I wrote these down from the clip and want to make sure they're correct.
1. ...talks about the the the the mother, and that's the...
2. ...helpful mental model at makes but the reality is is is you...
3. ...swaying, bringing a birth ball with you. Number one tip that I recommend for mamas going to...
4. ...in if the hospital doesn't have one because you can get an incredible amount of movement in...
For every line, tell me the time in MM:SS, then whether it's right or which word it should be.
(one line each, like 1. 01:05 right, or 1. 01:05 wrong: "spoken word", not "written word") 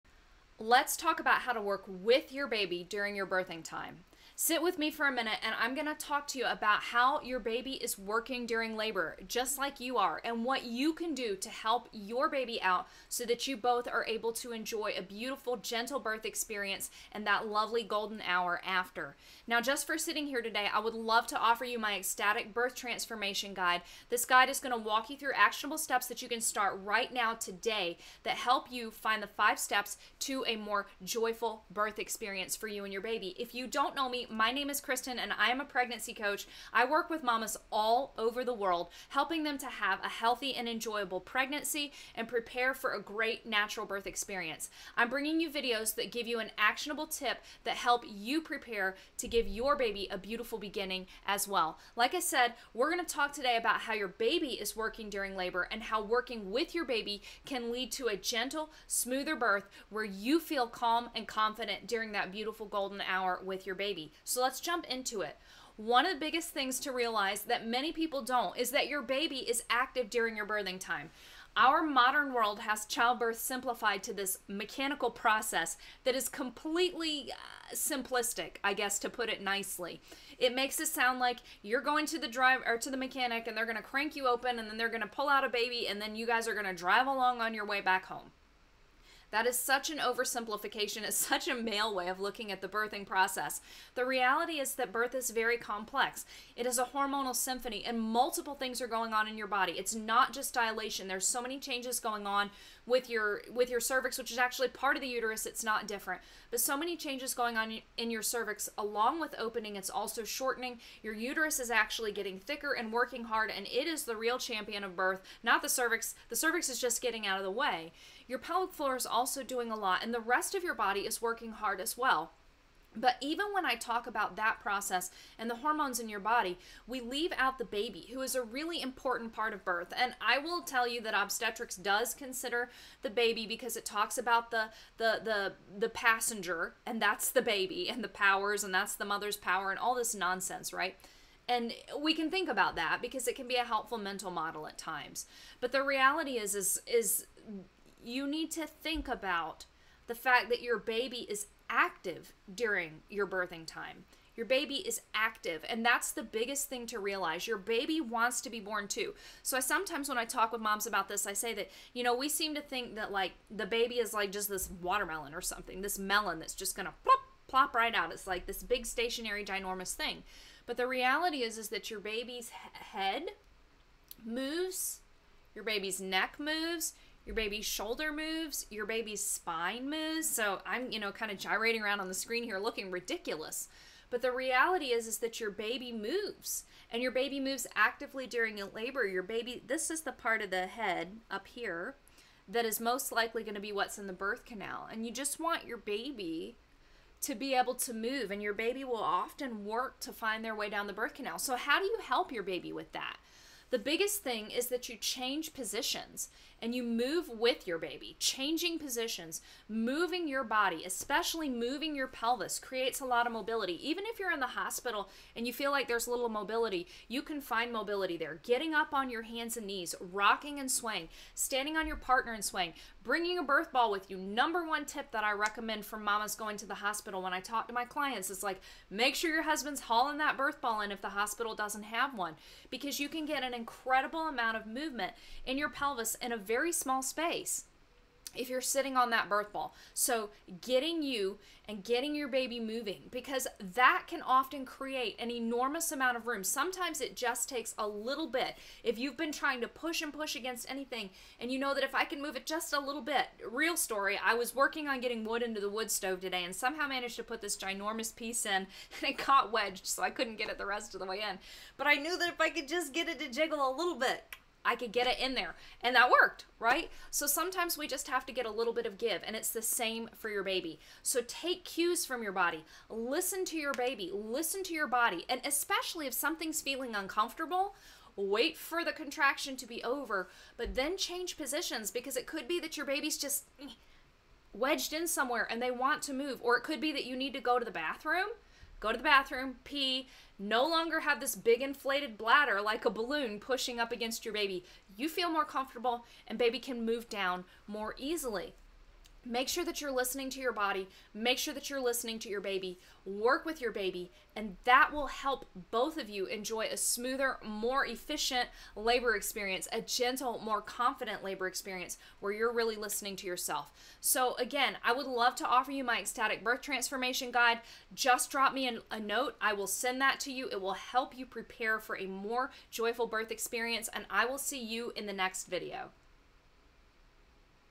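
1. 02:13 wrong: "passenger", not "mother"
2. 02:23 wrong: "times", not "makes"
3. 03:42 right
4. 03:50 right.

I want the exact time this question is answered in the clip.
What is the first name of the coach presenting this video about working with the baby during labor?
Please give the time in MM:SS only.
00:34.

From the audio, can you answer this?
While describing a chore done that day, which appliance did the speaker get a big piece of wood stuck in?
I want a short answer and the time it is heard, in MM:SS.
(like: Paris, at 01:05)
Wood stove, at 04:15.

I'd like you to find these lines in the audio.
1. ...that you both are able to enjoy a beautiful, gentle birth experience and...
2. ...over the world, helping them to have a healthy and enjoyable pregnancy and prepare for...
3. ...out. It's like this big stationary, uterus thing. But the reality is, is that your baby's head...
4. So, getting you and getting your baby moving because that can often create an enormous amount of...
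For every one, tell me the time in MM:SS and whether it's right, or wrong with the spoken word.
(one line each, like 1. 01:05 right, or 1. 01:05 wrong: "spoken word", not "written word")
1. 00:13 right
2. 00:38 right
3. 02:47 wrong: "ginormous", not "uterus"
4. 03:59 right.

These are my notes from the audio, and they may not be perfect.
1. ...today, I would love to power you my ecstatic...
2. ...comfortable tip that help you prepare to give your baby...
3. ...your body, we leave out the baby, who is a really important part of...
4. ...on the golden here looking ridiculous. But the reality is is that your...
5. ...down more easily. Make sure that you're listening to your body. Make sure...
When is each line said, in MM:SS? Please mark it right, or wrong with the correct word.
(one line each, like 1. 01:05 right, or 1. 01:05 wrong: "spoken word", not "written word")
1. 00:20 wrong: "offer", not "power"
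2. 00:46 wrong: "actionable", not "comfortable"
3. 02:06 right
4. 03:01 wrong: "screen", not "golden"
5. 04:57 right.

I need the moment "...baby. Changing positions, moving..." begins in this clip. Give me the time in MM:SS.
03:27.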